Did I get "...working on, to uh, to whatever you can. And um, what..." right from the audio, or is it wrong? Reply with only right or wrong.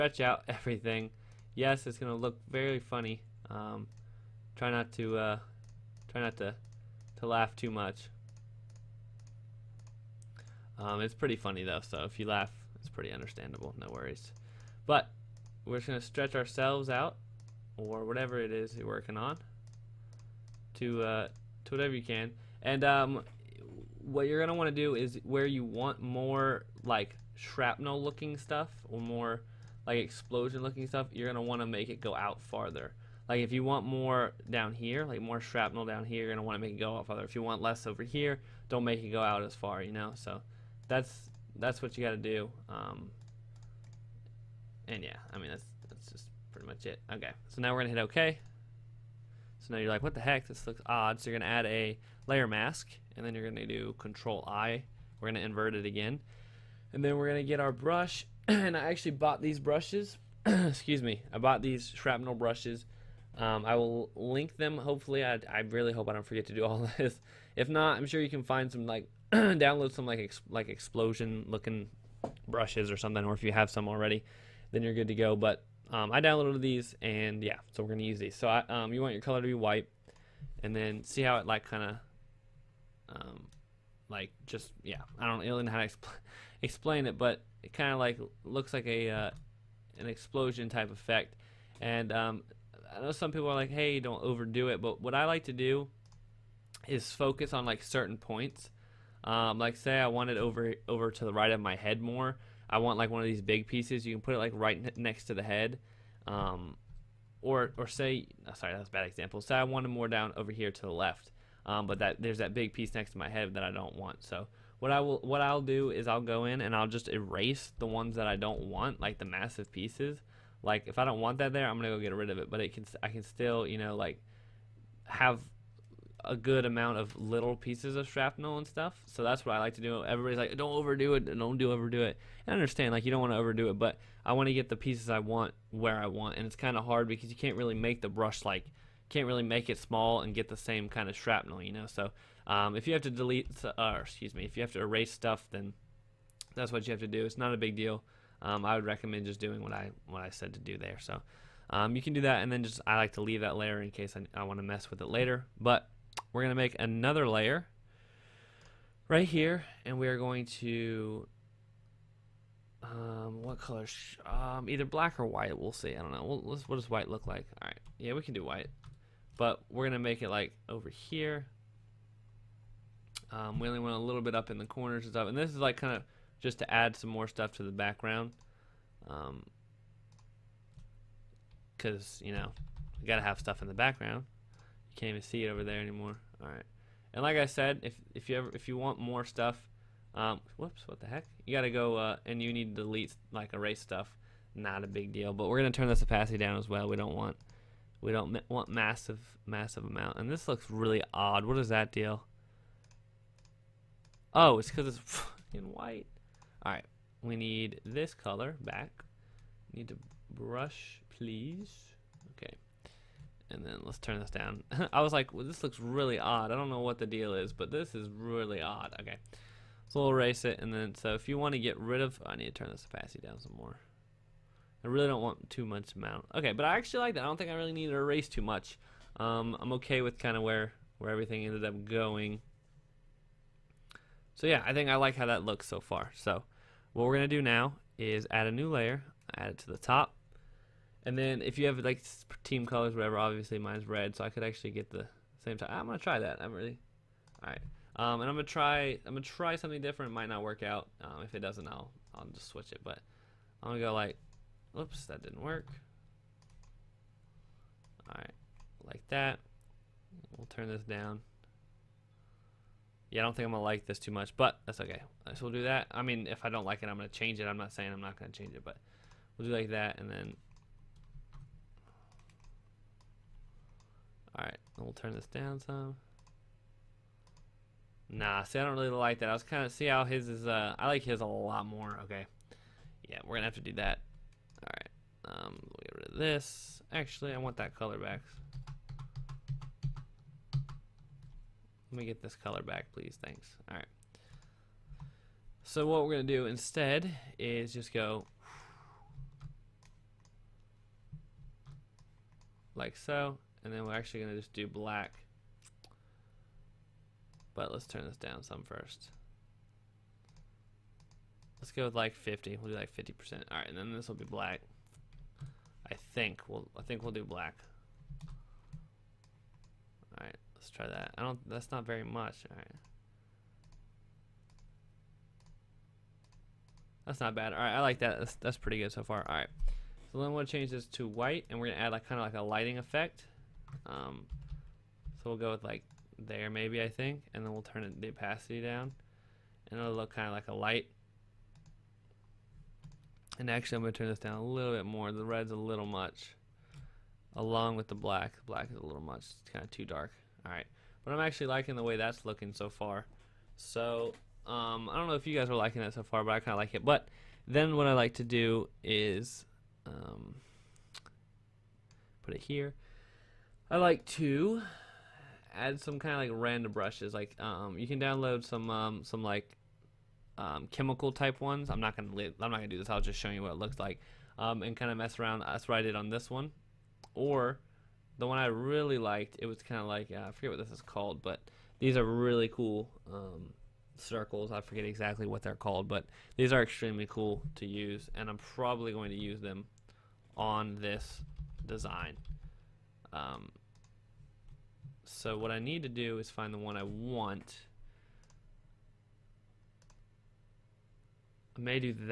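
right.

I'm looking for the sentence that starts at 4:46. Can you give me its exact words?
Actually, I want that color back.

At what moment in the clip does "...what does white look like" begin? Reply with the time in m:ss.
2:46.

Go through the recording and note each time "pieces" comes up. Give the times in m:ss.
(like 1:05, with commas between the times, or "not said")
1:43, 1:52, 1:59, 2:07, 2:14.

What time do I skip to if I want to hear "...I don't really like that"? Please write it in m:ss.
4:38.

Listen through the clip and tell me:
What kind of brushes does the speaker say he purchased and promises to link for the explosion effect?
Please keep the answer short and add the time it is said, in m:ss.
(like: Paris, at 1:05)
shrapnel brushes, at 1:01.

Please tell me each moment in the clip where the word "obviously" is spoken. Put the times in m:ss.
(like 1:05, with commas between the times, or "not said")
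4:03.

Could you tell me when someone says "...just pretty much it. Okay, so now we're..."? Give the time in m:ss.
0:46.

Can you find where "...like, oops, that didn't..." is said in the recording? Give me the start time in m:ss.
4:13.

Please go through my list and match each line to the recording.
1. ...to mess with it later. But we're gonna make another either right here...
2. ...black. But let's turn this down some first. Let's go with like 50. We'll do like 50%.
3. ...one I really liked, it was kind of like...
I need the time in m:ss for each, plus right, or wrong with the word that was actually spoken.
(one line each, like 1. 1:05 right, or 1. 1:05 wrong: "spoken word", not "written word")
1. 2:34 wrong: "layer", not "either"
2. 5:04 right
3. 6:18 right.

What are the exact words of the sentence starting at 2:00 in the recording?
Like if I don't want that there, I'm gonna go get rid of it.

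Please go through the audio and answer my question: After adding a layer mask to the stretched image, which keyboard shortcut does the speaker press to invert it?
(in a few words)
Control I.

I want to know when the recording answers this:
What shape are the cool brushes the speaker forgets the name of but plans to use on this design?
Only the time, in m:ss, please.
6:23.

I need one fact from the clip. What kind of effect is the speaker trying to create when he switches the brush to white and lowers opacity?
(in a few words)
lighting effect.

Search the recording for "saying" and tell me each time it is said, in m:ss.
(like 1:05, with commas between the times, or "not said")
4:27.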